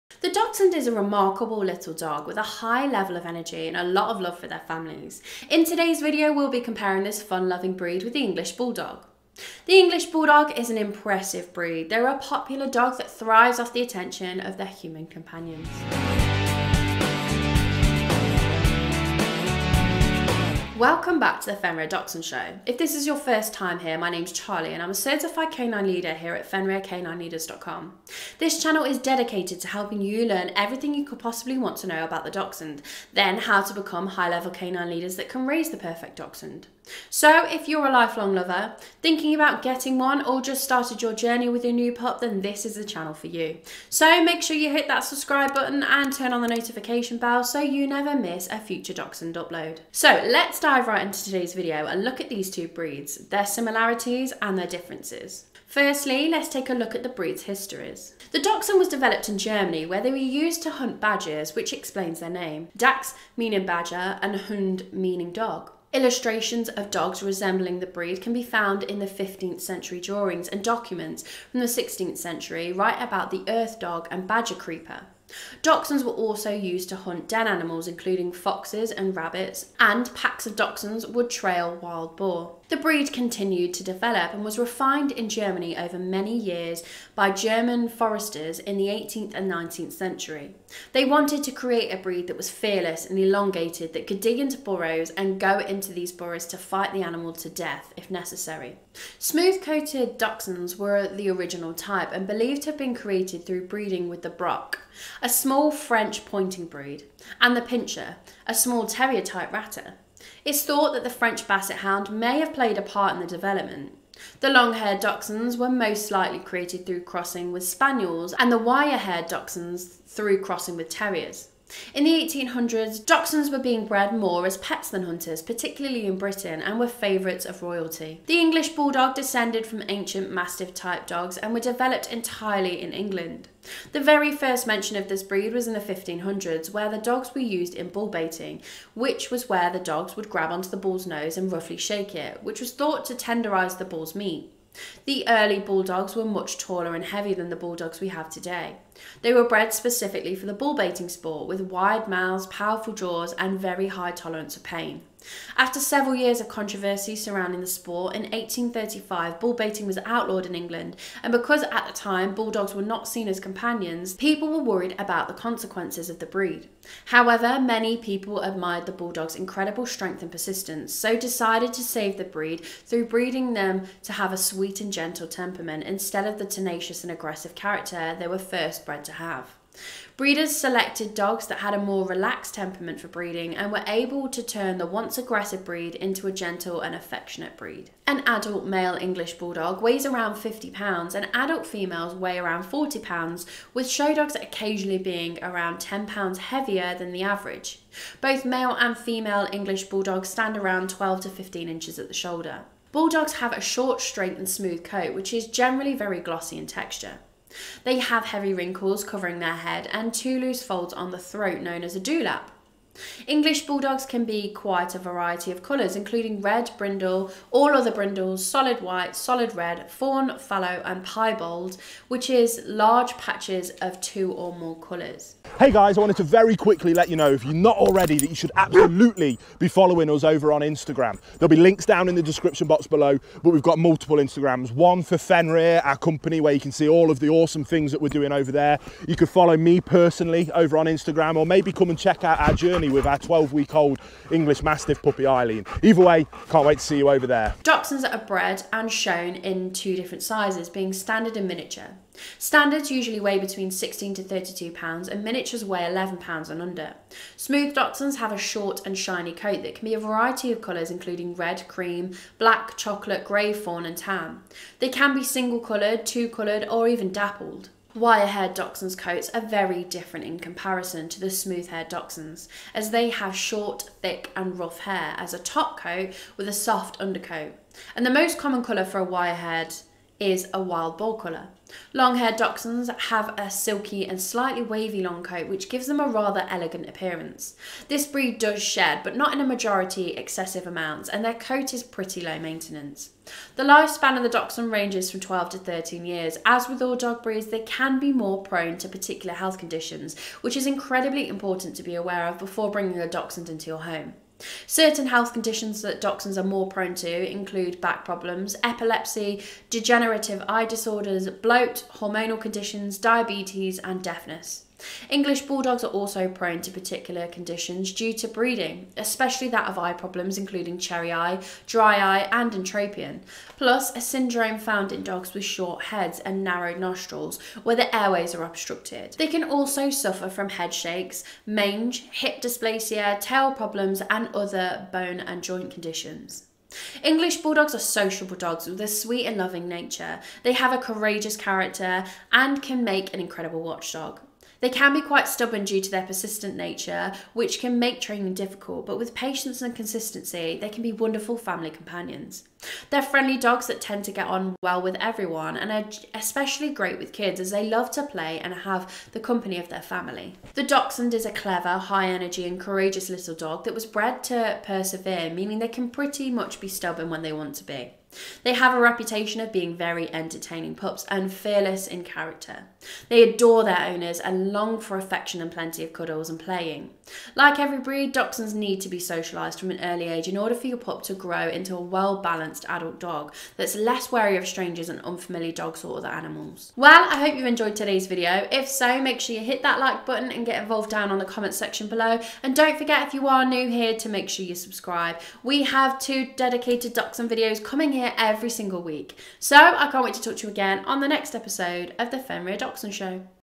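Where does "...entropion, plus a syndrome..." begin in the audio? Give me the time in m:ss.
5:22.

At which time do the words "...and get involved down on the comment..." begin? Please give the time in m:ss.
6:30.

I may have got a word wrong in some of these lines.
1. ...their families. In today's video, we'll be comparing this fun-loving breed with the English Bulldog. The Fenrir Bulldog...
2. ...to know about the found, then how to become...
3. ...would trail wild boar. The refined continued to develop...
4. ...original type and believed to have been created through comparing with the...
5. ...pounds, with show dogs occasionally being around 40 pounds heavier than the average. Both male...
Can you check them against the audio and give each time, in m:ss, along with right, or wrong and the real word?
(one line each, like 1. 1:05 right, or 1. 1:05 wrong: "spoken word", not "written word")
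1. 0:04 wrong: "English", not "Fenrir"
2. 0:31 wrong: "dachshund", not "found"
3. 1:21 wrong: "breed", not "refined"
4. 1:41 wrong: "breeding", not "comparing"
5. 3:12 wrong: "10", not "40".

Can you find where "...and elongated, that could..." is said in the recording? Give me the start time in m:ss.
1:33.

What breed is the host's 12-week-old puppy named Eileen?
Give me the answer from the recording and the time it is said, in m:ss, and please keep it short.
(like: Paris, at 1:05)
English Mastiff, at 4:04.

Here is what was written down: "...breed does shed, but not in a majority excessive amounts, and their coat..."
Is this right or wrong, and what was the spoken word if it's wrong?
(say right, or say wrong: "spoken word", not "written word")
right.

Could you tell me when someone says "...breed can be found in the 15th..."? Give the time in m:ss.
1:07.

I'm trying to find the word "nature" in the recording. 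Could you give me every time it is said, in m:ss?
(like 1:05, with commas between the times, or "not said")
5:39, 5:46.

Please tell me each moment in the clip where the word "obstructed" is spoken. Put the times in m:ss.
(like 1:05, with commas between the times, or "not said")
5:28.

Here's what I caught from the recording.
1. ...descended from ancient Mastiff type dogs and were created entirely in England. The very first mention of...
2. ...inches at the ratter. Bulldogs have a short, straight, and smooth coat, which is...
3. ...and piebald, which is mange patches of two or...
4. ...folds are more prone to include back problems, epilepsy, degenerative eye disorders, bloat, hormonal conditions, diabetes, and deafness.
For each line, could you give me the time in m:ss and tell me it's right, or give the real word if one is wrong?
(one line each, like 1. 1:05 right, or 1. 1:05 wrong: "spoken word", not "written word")
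1. 2:09 wrong: "developed", not "created"
2. 3:21 wrong: "shoulder", not "ratter"
3. 3:40 wrong: "large", not "mange"
4. 5:06 wrong: "dachshunds", not "folds".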